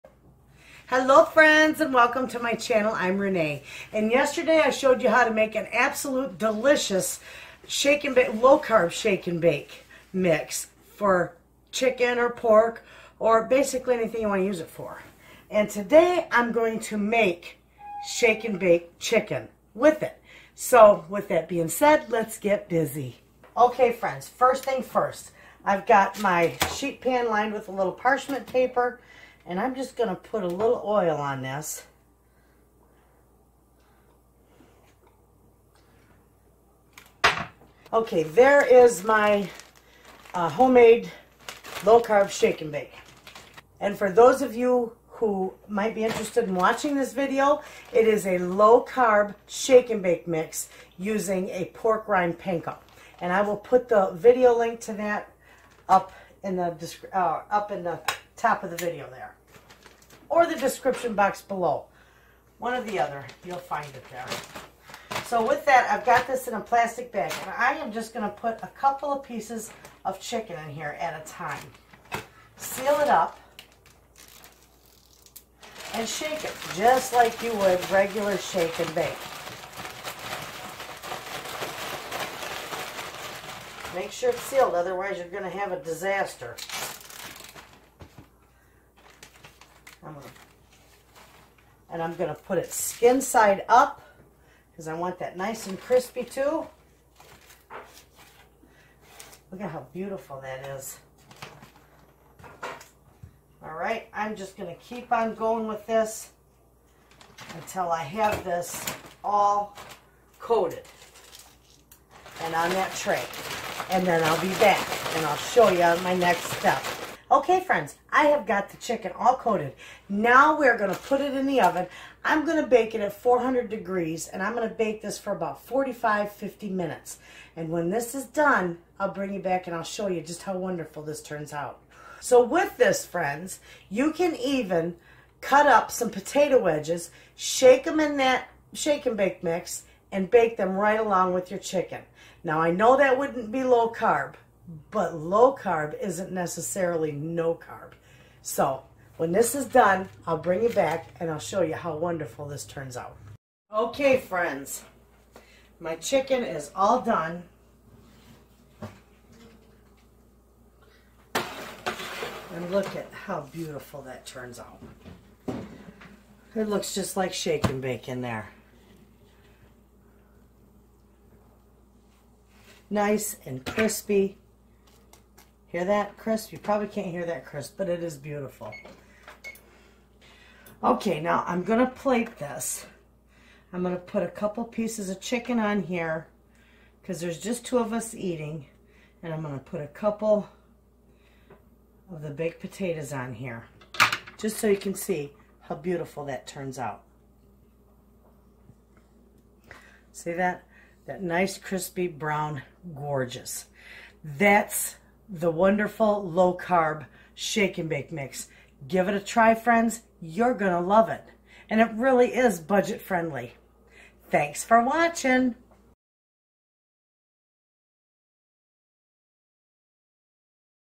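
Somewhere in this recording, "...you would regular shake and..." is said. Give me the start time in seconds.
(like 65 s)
77 s.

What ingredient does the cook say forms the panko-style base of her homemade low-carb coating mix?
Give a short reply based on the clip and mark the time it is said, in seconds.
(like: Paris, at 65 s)
pork rind panko, at 51 s.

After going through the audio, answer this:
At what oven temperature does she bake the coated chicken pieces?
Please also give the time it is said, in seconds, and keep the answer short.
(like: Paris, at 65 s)
400 degrees, at 123 s.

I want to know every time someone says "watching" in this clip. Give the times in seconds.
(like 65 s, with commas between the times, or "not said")
46 s, 214 s.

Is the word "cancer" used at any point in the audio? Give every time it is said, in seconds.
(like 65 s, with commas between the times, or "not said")
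not said.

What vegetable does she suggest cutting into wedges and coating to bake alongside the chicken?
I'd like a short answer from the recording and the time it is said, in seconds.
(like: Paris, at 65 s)
potato, at 136 s.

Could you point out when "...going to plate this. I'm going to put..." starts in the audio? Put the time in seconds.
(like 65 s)
181 s.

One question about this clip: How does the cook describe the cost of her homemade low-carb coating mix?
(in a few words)
budget friendly.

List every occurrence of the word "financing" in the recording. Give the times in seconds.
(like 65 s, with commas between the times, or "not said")
not said.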